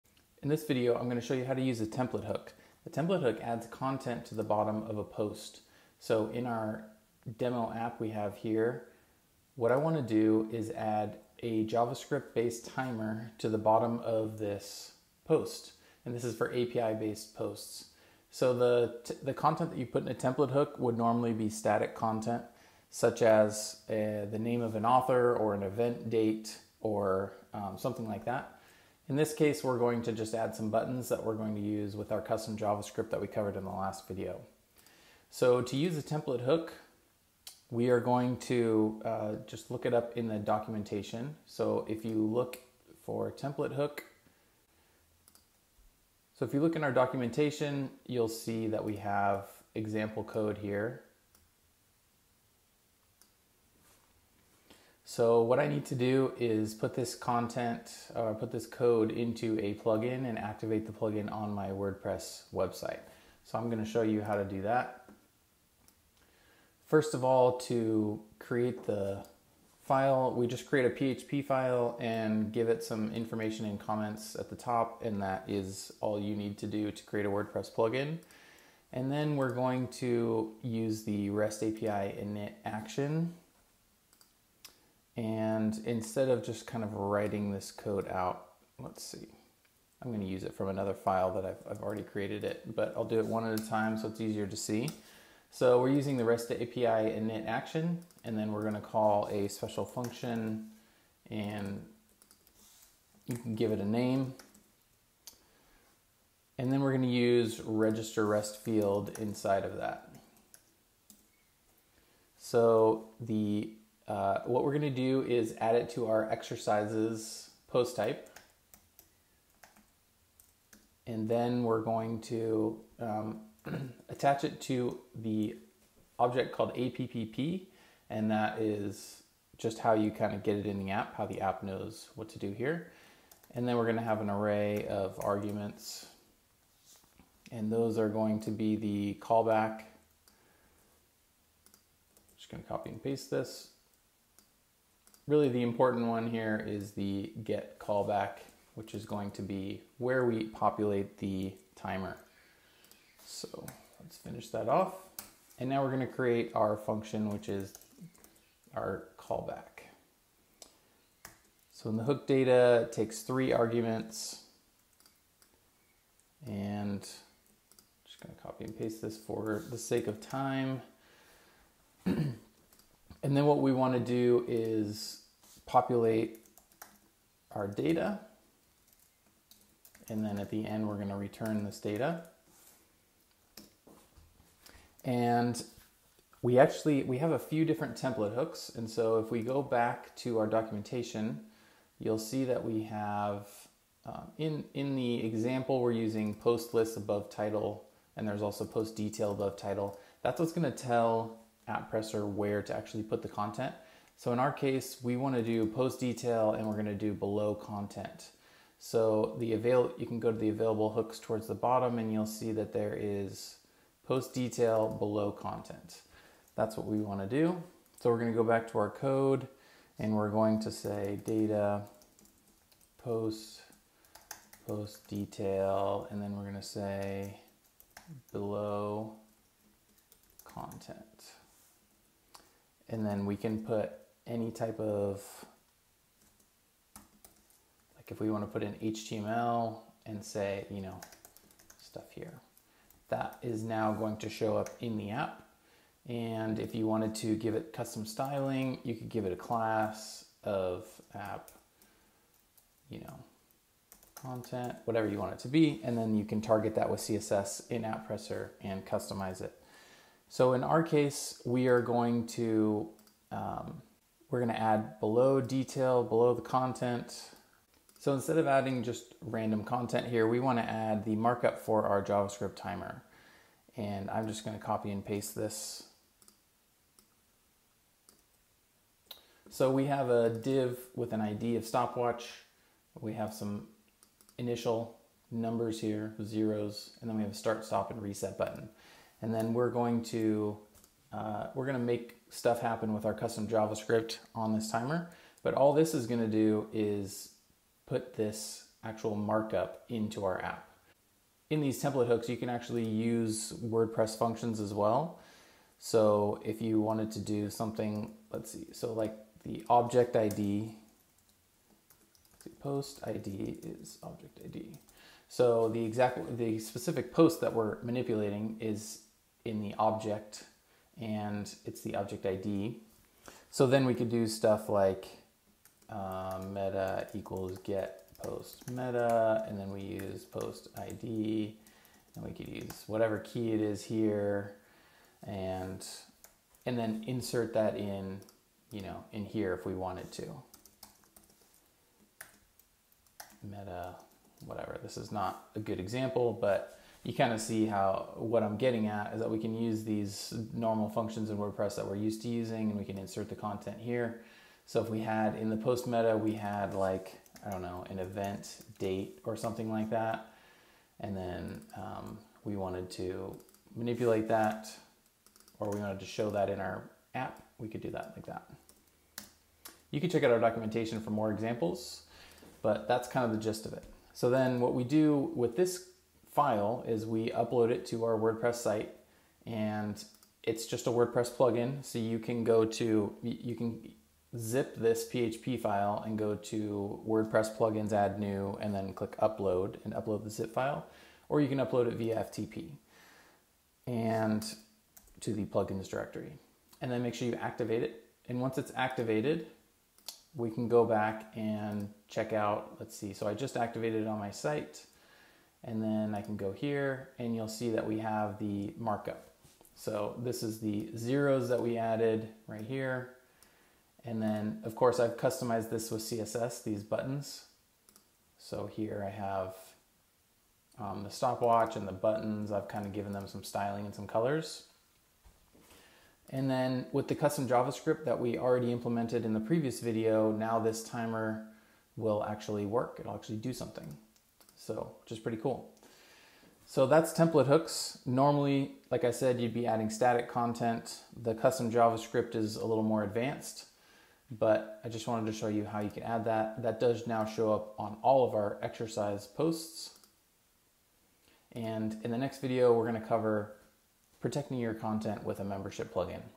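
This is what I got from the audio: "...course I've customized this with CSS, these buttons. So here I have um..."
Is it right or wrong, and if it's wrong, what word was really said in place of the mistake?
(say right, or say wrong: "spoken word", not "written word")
right.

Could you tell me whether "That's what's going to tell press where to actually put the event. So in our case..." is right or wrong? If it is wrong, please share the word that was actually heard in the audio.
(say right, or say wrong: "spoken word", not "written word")
wrong: "content", not "event".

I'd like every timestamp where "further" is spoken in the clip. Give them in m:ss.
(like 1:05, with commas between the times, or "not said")
not said.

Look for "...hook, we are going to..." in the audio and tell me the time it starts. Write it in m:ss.
0:36.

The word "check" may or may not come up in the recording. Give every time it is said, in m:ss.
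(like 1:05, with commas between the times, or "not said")
6:10, 6:42.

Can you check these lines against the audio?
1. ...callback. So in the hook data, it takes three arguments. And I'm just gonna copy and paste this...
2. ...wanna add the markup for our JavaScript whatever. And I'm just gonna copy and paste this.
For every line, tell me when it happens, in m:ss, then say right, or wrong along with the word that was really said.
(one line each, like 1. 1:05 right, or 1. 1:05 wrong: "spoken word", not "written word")
1. 2:39 right
2. 4:30 wrong: "timer", not "whatever".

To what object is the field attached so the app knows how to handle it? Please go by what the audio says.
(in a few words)
APPP.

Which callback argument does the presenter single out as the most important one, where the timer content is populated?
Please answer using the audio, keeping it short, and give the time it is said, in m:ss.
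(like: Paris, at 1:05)
get callback, at 2:27.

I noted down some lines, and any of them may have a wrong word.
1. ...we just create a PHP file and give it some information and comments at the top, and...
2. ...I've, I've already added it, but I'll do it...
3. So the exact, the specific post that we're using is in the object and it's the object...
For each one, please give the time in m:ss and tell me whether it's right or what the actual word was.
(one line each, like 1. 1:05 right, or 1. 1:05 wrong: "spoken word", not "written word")
1. 1:10 right
2. 1:31 wrong: "created", not "added"
3. 5:15 wrong: "manipulating", not "using".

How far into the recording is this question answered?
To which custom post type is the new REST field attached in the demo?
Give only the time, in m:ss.
1:56.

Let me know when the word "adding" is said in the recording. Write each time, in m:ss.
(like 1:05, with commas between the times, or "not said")
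4:28, 7:19.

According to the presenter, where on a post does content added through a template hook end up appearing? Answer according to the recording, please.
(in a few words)
bottom of a post.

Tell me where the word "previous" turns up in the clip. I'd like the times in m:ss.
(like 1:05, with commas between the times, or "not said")
7:09.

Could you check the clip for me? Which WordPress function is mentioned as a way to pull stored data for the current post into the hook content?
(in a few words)
get post meta.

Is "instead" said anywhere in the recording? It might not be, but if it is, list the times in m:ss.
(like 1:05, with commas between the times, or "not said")
1:25, 4:28.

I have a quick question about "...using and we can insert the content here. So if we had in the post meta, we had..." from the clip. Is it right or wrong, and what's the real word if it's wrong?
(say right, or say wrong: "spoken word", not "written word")
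right.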